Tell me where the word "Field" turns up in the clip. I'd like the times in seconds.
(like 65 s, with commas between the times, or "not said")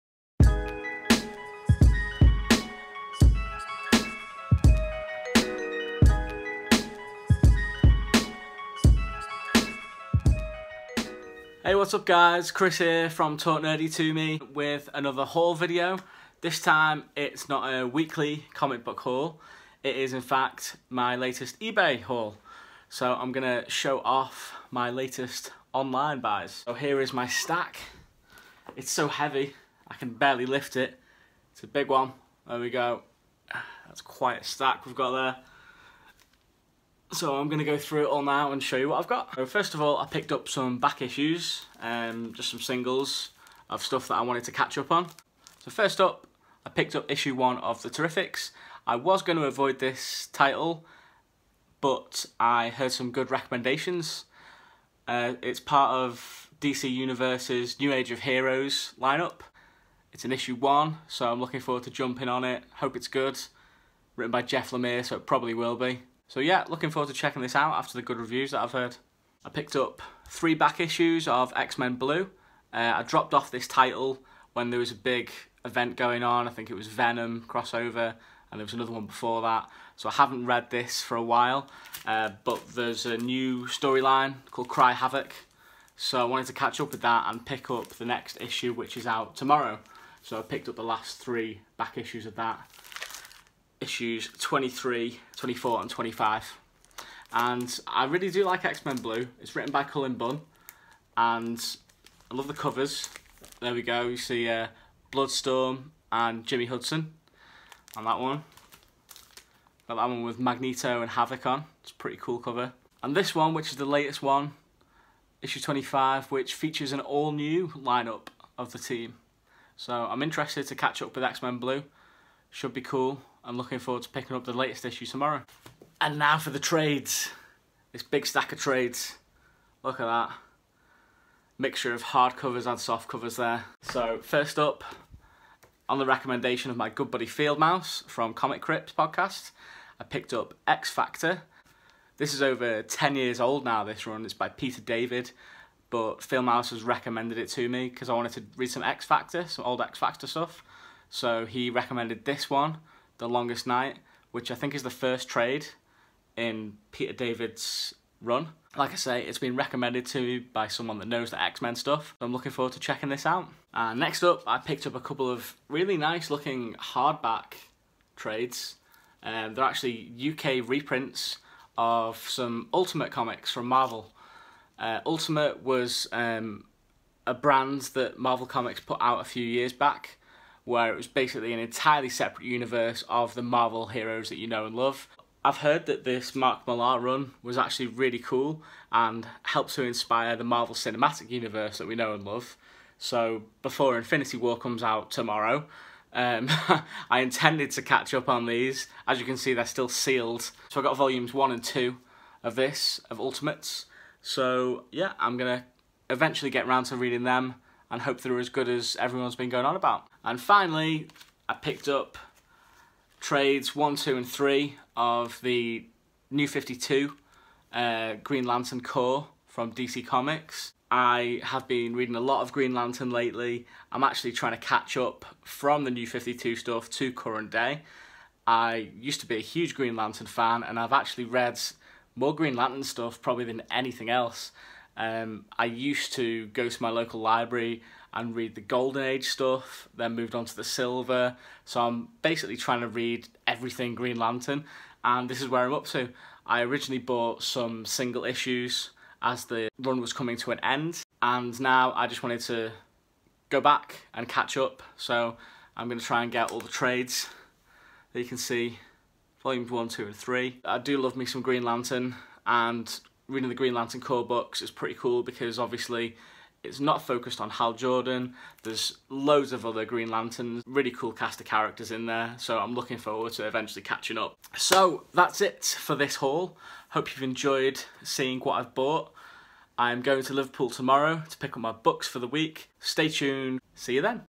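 137 s, 146 s.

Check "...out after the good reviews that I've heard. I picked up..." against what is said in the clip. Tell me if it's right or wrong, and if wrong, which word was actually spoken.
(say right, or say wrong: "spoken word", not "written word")
right.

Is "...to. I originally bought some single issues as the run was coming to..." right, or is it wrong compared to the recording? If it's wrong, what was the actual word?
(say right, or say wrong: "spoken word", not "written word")
right.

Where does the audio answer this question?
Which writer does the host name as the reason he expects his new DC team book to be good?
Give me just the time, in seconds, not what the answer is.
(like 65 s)
64 s.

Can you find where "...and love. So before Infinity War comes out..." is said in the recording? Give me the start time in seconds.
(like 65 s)
192 s.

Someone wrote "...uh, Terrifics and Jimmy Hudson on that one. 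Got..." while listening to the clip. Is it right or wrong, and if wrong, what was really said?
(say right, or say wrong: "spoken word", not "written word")
wrong: "Bloodstorm", not "Terrifics".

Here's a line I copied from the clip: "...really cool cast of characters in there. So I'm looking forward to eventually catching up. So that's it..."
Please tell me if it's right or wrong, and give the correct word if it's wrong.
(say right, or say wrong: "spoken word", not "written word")
right.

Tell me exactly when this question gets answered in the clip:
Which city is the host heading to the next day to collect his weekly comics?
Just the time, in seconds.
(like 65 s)
280 s.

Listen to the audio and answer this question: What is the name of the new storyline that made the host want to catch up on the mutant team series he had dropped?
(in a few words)
Cry Havoc.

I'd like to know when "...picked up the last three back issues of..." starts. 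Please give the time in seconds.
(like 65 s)
90 s.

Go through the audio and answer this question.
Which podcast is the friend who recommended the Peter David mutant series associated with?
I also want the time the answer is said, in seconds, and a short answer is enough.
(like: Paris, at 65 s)
Comic Crypt, at 138 s.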